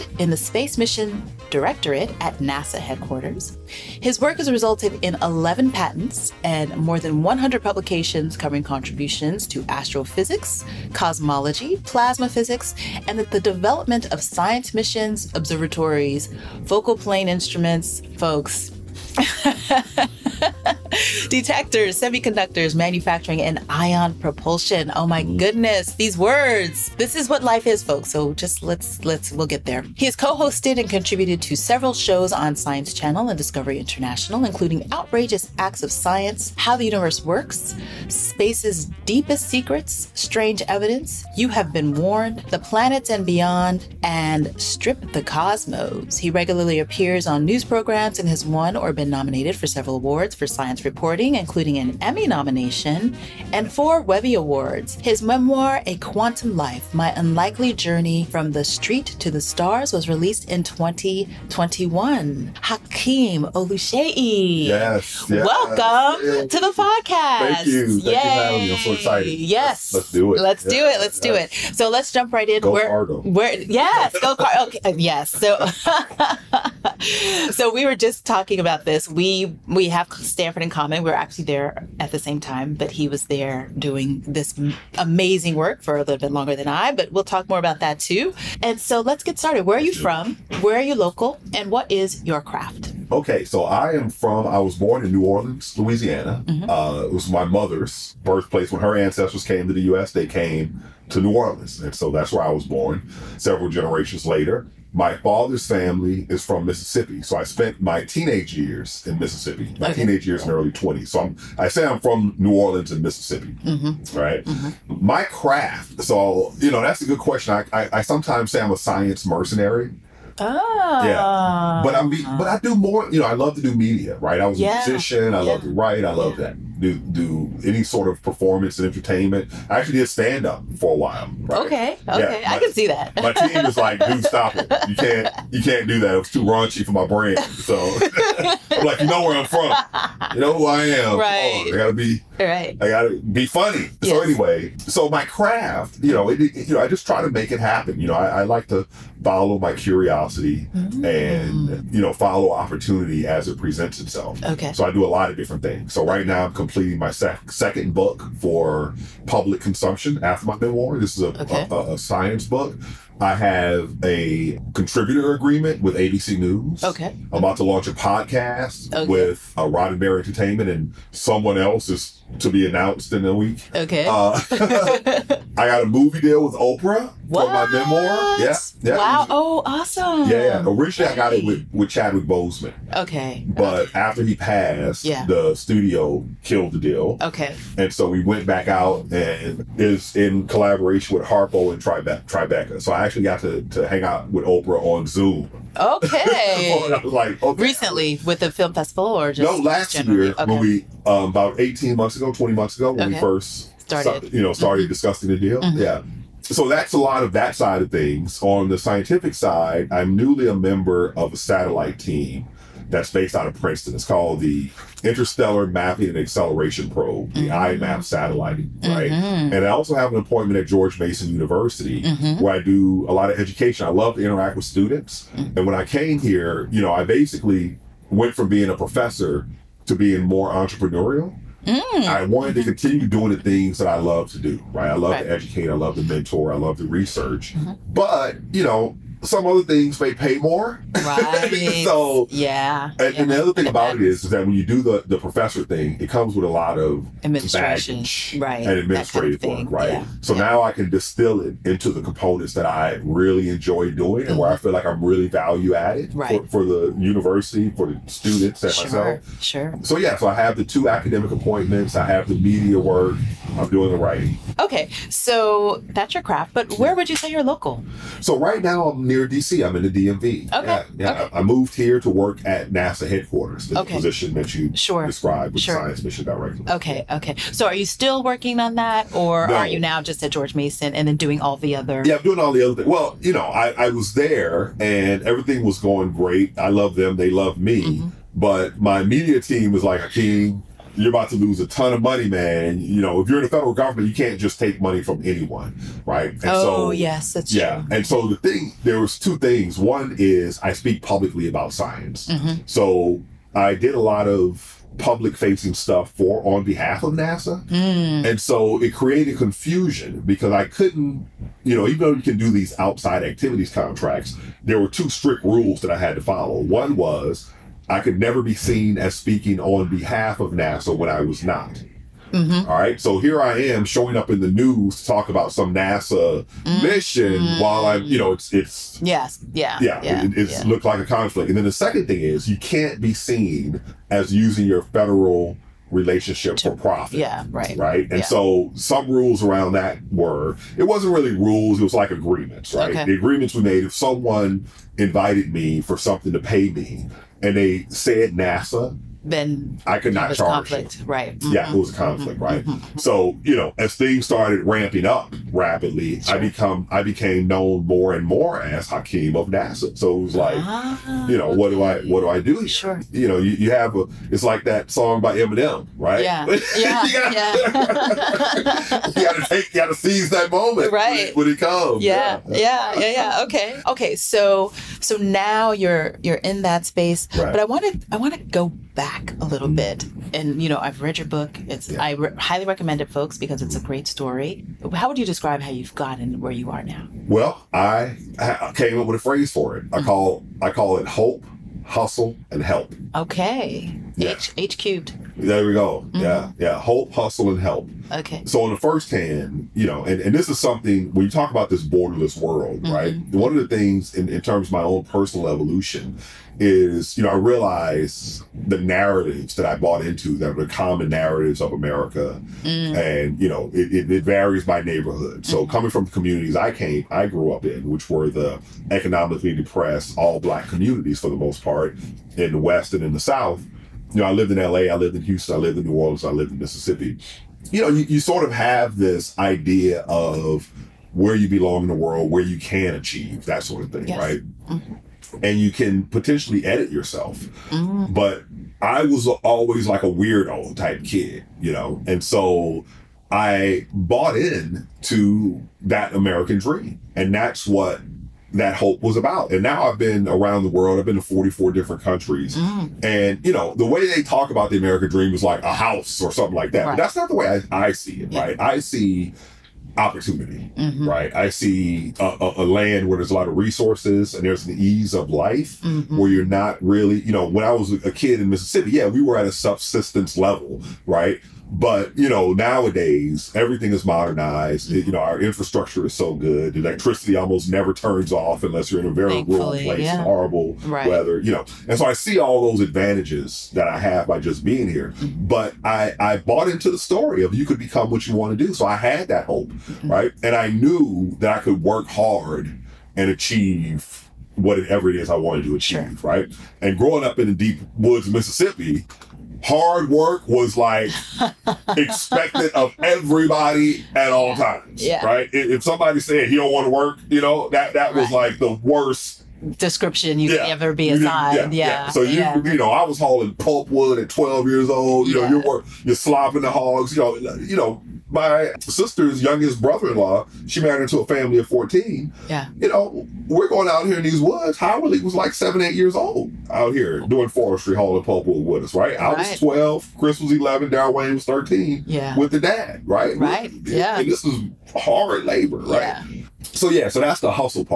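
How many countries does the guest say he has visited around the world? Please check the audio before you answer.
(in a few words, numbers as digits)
44.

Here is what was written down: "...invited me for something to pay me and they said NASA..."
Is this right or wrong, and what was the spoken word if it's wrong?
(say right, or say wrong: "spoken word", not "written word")
right.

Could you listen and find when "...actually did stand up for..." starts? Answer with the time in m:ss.
2:09.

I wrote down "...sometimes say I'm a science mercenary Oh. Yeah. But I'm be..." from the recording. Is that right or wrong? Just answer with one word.
right.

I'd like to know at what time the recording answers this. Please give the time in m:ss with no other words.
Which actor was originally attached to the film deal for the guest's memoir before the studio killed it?
3:01.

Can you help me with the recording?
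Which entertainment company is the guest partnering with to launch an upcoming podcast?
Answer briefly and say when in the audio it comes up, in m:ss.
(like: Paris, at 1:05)
Roddenberry Entertainment, at 2:49.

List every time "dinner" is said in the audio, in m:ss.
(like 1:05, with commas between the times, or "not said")
not said.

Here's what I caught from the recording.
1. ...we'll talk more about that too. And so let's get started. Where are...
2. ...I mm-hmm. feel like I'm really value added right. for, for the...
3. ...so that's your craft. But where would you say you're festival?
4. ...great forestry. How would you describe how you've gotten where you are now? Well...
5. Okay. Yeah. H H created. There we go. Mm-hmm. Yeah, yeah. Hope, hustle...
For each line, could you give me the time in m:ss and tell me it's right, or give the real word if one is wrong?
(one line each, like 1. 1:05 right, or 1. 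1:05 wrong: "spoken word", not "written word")
1. 1:27 right
2. 4:14 right
3. 4:25 wrong: "local", not "festival"
4. 6:23 wrong: "story", not "forestry"
5. 6:33 wrong: "cubed", not "created".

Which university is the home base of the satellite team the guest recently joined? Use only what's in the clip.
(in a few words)
Princeton.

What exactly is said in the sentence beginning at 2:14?
You can't you can't do that.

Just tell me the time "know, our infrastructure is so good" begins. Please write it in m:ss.
7:55.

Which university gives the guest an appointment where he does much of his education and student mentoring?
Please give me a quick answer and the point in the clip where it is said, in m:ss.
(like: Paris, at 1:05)
George Mason University, at 3:40.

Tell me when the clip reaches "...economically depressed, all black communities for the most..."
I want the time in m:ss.
6:58.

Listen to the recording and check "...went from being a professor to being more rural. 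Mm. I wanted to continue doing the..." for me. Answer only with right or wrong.
wrong.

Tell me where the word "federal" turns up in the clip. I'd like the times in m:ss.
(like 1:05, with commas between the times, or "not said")
4:53, 5:34.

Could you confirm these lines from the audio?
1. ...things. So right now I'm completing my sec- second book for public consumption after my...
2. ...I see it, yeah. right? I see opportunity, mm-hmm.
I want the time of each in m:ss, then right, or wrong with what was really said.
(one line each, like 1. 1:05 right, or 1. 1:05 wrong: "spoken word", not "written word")
1. 2:35 right
2. 7:37 right.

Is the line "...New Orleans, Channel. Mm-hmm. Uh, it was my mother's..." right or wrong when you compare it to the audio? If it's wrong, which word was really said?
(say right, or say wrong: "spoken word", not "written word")
wrong: "Louisiana", not "Channel".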